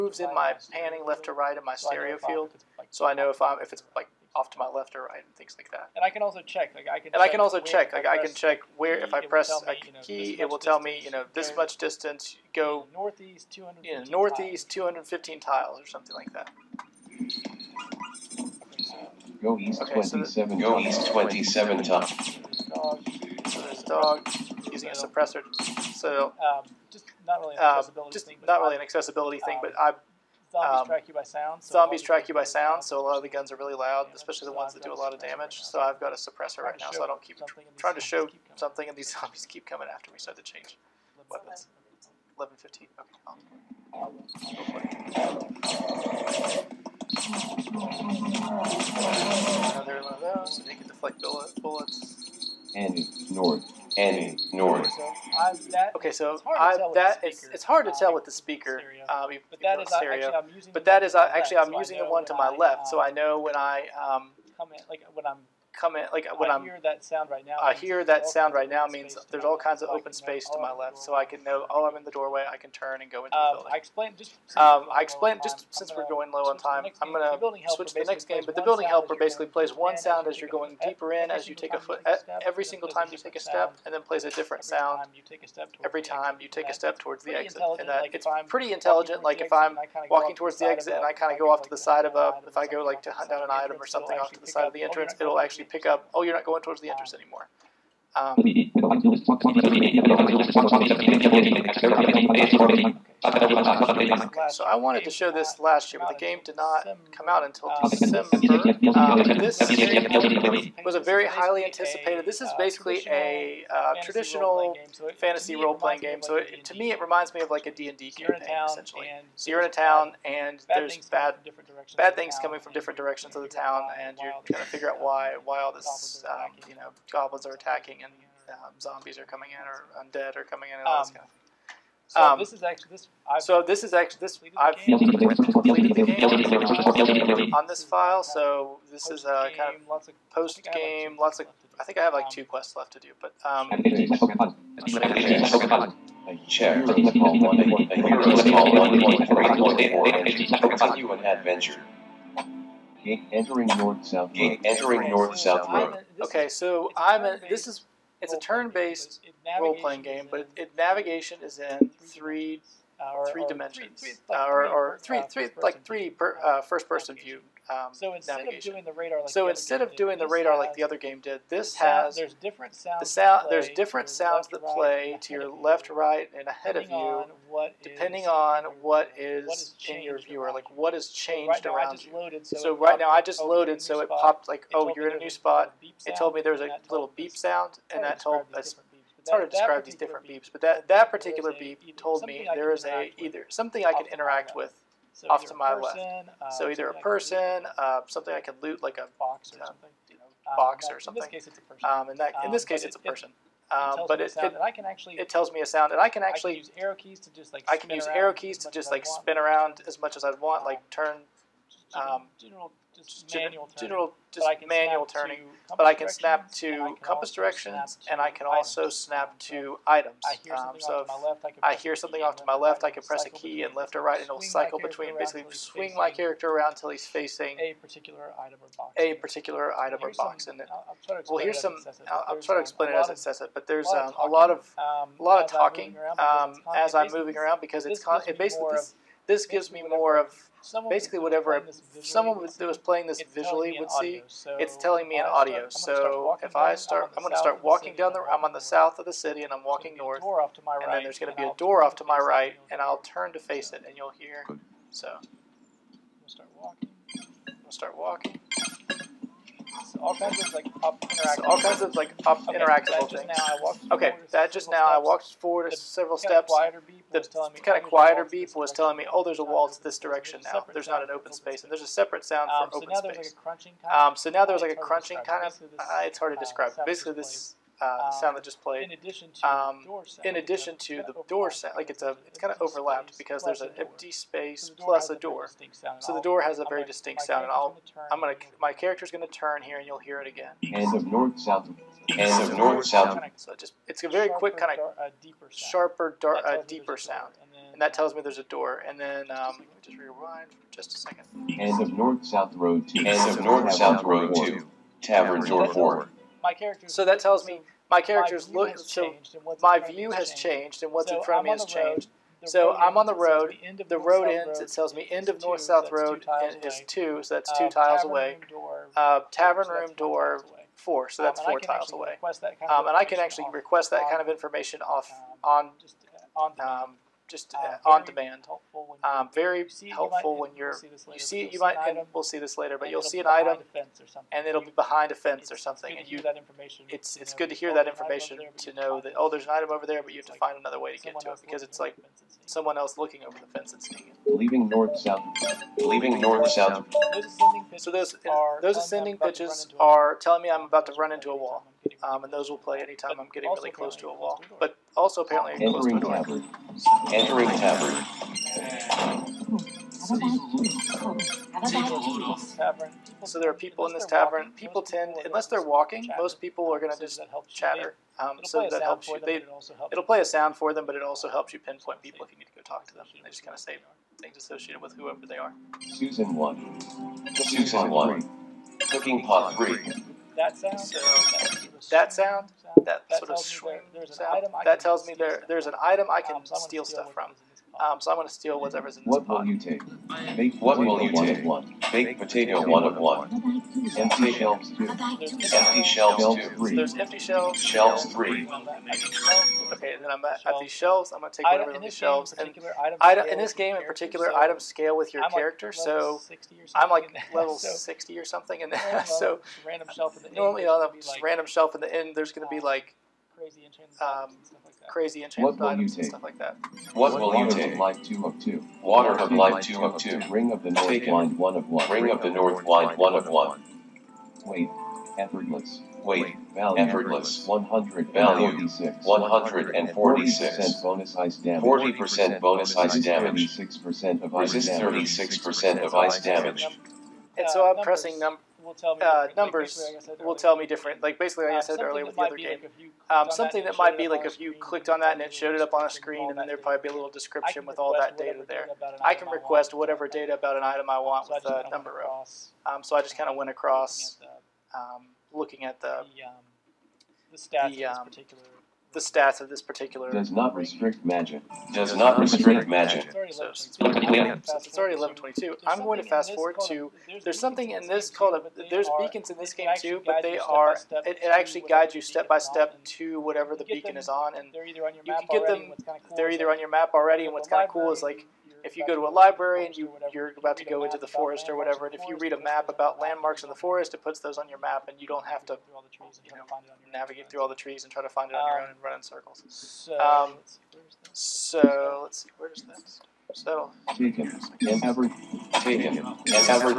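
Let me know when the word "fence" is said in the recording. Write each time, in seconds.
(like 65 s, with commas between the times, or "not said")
335 s, 343 s.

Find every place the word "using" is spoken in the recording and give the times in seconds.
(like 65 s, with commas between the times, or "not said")
24 s, 61 s.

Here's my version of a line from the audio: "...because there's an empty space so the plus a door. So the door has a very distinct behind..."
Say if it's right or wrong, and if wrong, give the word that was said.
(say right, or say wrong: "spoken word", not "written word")
wrong: "sound", not "behind".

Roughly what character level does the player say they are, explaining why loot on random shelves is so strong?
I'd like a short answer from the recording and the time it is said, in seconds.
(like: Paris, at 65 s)
60, at 407 s.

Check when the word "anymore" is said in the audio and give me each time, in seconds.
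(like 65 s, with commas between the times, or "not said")
97 s.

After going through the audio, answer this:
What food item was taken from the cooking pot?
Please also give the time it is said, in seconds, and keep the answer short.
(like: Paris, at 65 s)
baked potato, at 391 s.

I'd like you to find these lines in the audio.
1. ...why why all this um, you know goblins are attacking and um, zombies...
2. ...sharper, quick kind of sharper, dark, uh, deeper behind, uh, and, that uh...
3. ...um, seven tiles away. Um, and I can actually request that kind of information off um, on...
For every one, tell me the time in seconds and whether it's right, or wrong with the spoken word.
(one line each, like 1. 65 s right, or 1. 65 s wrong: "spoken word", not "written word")
1. 124 s right
2. 294 s wrong: "sound", not "behind"
3. 321 s wrong: "four", not "seven".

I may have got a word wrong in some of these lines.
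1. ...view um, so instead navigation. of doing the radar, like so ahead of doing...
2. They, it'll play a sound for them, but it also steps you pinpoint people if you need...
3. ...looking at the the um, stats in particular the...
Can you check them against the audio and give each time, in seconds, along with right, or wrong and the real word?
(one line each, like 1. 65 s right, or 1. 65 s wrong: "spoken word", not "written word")
1. 167 s wrong: "instead", not "ahead"
2. 369 s wrong: "helps", not "steps"
3. 455 s right.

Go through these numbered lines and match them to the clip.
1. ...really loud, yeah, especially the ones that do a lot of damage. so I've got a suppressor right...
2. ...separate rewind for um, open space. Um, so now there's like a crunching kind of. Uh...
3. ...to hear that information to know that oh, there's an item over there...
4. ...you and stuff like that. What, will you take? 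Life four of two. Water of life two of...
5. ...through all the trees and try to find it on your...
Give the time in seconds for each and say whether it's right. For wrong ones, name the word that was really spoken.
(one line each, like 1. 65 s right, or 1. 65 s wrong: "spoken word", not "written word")
1. 33 s right
2. 271 s wrong: "sound", not "rewind"
3. 337 s right
4. 415 s wrong: "two", not "four"
5. 487 s right.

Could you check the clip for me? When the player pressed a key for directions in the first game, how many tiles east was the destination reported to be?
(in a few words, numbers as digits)
27.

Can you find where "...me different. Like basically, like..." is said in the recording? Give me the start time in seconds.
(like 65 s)
440 s.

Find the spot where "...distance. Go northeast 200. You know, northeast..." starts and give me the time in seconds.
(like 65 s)
11 s.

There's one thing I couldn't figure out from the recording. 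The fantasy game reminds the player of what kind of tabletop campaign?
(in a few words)
D&D.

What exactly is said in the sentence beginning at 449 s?
I can request whatever data about an item I want with the number row.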